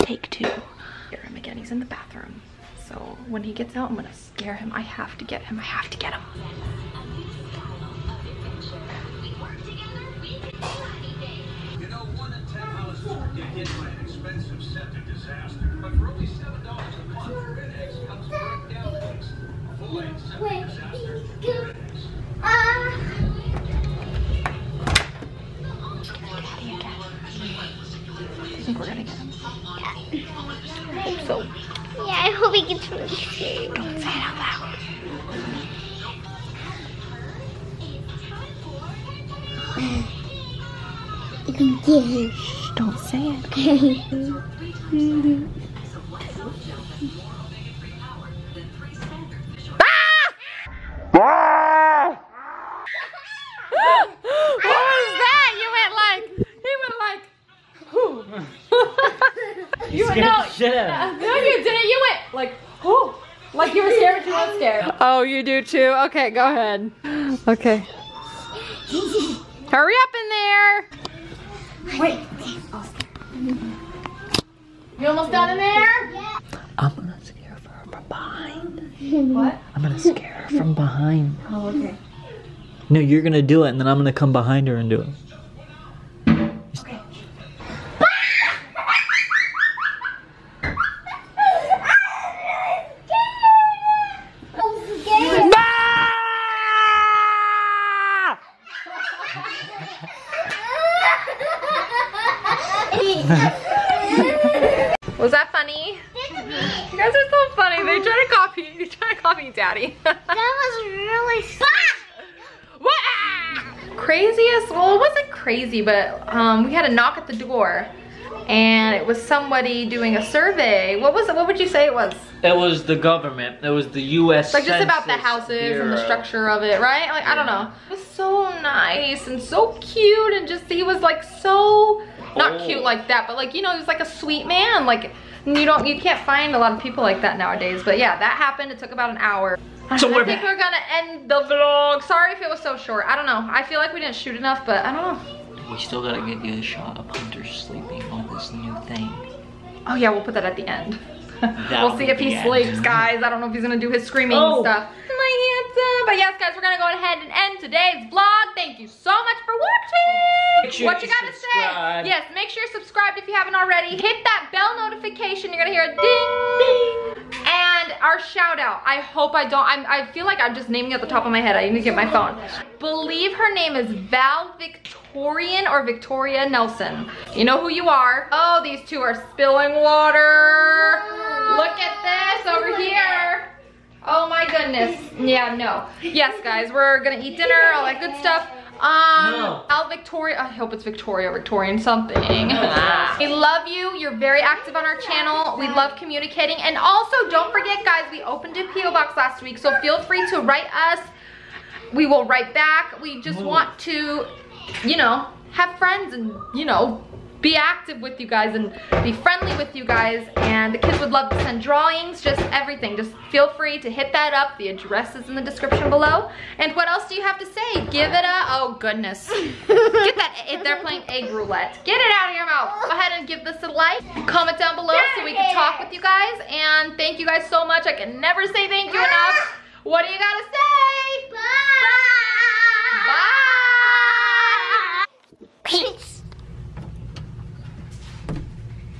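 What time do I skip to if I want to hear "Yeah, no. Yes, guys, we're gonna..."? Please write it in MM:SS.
03:05.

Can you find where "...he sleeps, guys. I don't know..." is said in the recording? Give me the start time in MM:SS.
02:32.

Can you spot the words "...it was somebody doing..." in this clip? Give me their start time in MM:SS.
01:58.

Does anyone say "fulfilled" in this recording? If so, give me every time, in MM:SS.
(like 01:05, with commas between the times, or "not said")
not said.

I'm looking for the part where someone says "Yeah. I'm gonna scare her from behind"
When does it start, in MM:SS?
01:16.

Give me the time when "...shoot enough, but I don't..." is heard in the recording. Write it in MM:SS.
02:24.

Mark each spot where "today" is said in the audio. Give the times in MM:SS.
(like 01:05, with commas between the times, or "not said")
02:37.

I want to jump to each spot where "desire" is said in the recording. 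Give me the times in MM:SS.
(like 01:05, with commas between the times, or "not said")
not said.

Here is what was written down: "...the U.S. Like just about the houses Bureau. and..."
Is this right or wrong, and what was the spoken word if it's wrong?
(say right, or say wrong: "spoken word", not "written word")
right.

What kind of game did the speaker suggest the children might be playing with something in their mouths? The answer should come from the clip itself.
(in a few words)
egg roulette.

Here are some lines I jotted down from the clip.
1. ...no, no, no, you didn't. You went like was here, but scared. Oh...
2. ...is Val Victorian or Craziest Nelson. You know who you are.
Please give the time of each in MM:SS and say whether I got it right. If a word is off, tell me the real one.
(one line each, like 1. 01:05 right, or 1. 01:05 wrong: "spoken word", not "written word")
1. 01:00 right
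2. 02:53 wrong: "Victoria", not "Craziest".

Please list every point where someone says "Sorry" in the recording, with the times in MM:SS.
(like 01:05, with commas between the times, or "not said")
02:22.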